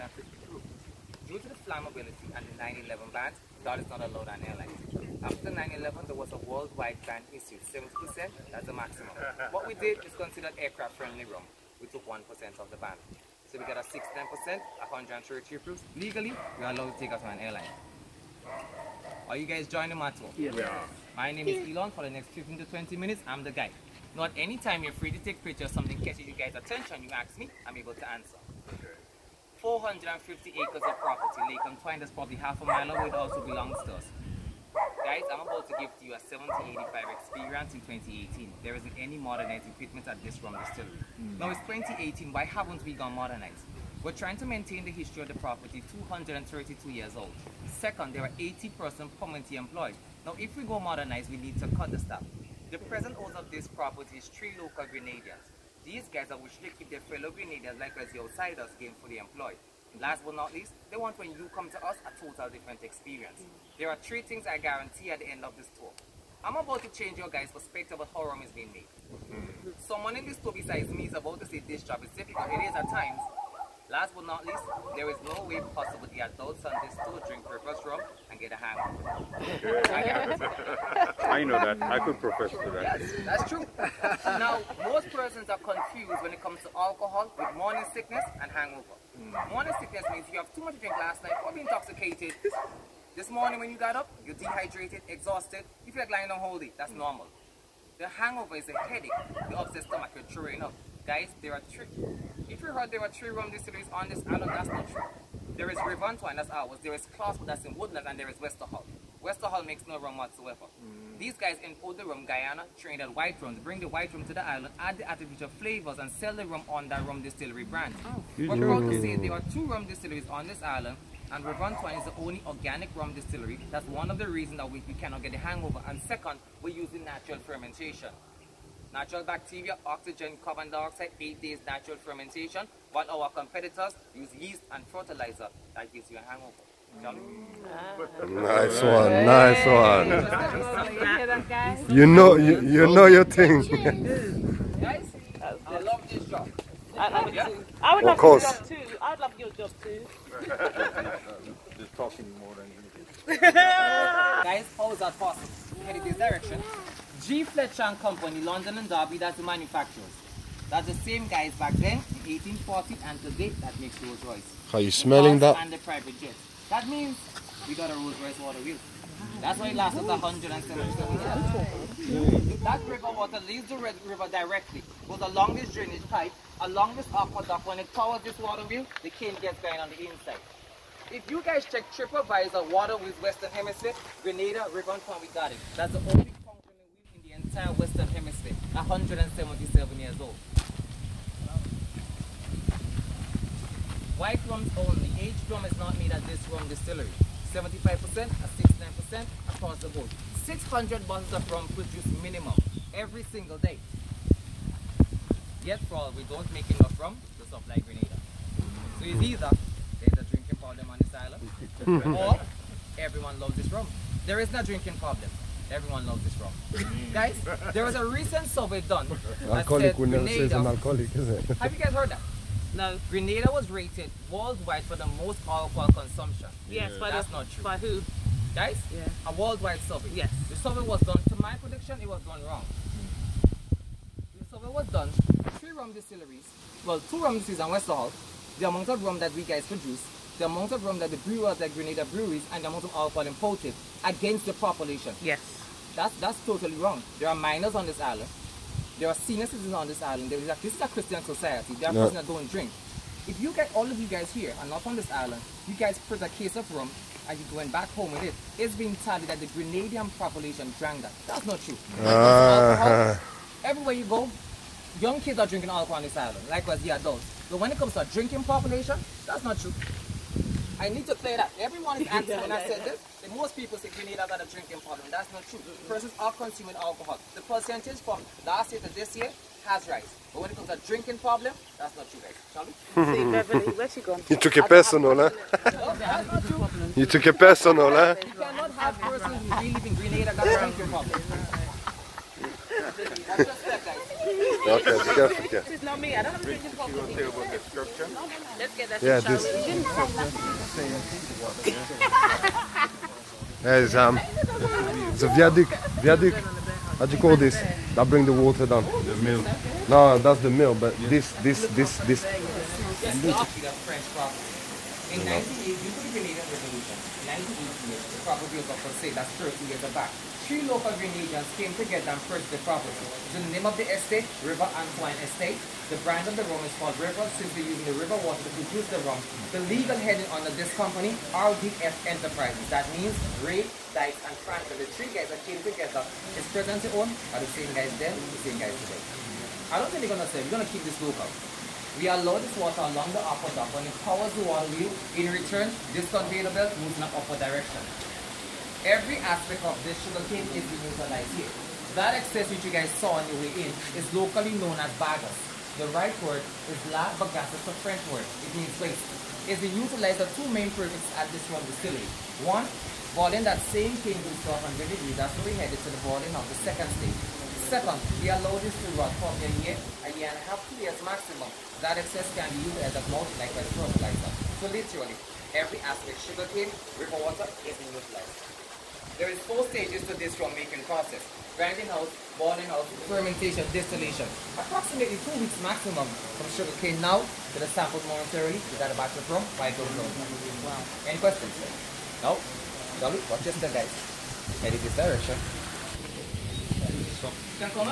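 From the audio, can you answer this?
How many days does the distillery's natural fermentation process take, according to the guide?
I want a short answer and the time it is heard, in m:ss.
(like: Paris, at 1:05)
8 days, at 2:11.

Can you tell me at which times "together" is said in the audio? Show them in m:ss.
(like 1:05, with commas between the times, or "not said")
5:21, 5:35.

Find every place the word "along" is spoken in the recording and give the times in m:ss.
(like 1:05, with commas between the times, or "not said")
2:56, 5:42.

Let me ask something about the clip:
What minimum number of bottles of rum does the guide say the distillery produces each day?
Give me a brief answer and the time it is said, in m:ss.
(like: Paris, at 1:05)
600, at 3:20.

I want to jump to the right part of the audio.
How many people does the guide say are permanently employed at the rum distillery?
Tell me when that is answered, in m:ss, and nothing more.
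0:48.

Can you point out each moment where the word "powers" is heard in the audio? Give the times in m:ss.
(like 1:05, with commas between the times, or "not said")
2:57, 5:44.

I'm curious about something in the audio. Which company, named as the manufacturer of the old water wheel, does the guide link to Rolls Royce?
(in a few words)
G. Fletcher and Company.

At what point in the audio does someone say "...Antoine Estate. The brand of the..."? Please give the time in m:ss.
5:24.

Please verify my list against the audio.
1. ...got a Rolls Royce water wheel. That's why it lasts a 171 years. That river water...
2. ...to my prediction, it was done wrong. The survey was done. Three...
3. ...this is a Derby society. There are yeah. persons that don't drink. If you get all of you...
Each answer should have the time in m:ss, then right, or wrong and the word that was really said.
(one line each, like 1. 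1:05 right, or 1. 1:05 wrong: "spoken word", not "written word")
1. 2:47 wrong: "177", not "171"
2. 3:51 right
3. 4:10 wrong: "Christian", not "Derby".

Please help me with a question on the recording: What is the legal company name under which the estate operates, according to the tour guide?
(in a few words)
RDF Enterprises.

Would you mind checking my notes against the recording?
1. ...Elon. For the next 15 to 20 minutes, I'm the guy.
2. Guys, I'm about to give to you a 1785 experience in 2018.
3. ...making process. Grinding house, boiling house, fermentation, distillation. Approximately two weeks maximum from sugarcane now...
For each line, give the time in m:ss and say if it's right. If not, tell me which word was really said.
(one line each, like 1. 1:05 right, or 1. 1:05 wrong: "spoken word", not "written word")
1. 0:21 right
2. 0:35 right
3. 6:20 right.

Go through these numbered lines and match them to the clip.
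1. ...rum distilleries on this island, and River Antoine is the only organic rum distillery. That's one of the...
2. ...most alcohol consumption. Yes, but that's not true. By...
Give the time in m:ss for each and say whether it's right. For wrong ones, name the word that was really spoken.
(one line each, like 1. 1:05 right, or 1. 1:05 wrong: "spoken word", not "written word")
1. 1:59 right
2. 3:45 right.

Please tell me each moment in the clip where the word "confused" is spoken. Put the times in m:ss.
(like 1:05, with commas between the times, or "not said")
1:25.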